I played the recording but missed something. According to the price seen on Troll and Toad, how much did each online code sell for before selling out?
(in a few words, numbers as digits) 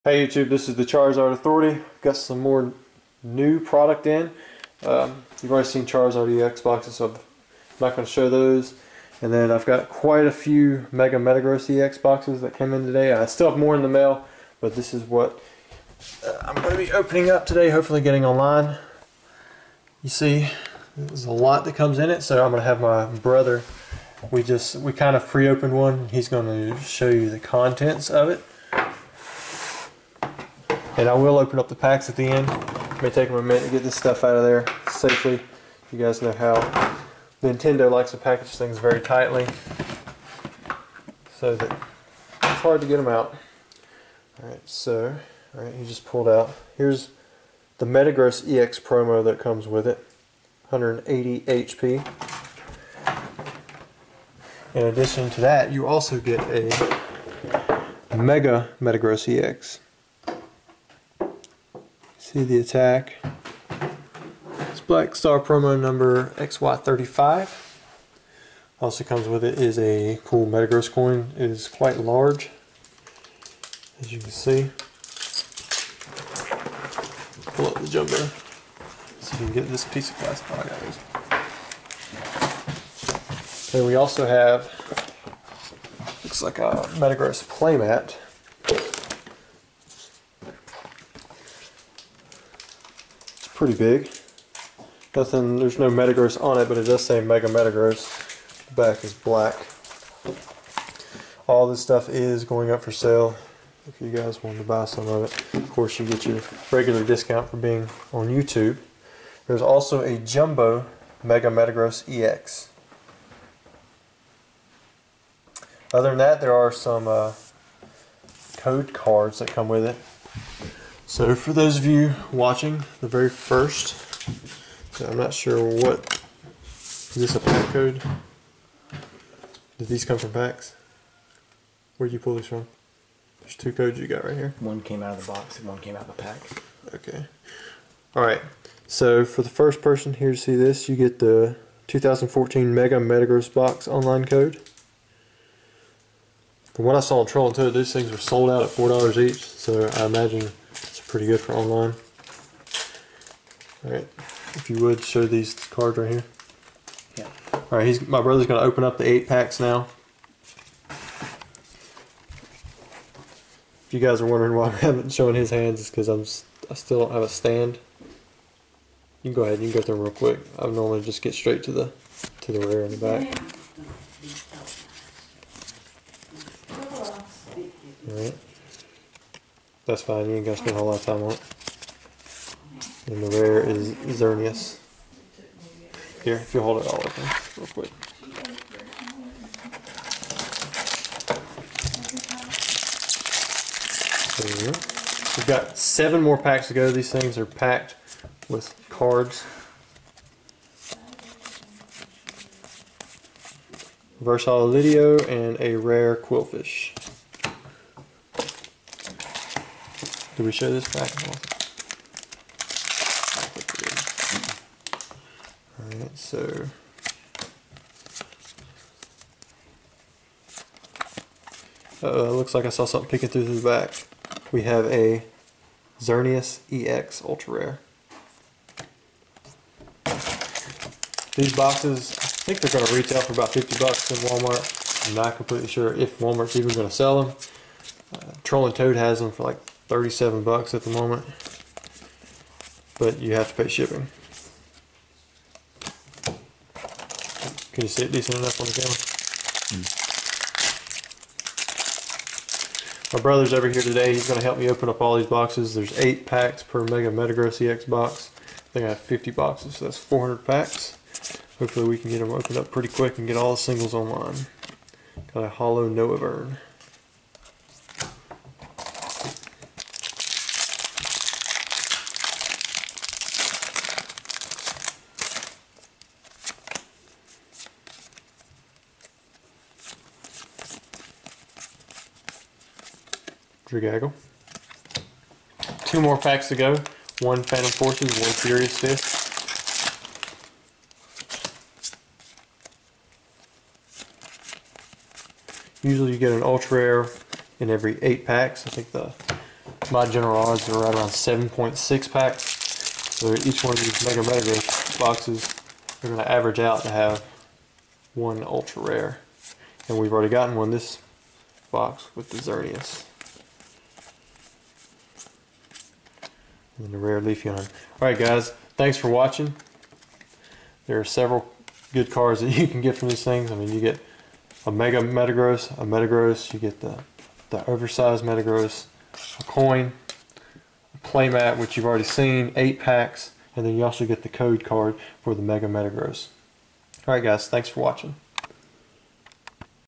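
$4.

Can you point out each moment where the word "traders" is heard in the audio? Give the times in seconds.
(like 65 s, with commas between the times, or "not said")
not said.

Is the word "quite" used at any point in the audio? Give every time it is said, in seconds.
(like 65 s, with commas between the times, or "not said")
9 s, 71 s.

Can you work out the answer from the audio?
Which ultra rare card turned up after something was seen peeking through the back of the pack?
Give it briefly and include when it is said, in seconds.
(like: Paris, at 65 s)
Xerneas EX, at 225 s.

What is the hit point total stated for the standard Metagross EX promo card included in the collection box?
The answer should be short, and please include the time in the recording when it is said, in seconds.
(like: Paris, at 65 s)
180 HP, at 50 s.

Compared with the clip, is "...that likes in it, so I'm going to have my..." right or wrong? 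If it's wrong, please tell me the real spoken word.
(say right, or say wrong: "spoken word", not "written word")
wrong: "comes", not "likes".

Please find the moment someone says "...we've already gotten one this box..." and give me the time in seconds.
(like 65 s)
309 s.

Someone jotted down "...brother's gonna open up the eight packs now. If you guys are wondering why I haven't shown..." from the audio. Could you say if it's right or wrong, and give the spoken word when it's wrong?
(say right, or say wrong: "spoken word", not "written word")
right.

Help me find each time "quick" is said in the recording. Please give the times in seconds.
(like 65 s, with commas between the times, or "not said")
170 s, 187 s, 262 s.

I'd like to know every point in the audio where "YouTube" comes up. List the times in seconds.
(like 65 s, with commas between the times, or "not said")
0 s, 108 s.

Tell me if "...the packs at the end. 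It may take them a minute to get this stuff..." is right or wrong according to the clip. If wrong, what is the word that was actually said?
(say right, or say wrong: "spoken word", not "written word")
right.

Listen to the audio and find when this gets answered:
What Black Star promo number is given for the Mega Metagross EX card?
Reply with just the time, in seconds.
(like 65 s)
66 s.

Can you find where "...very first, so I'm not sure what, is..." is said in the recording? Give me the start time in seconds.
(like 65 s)
123 s.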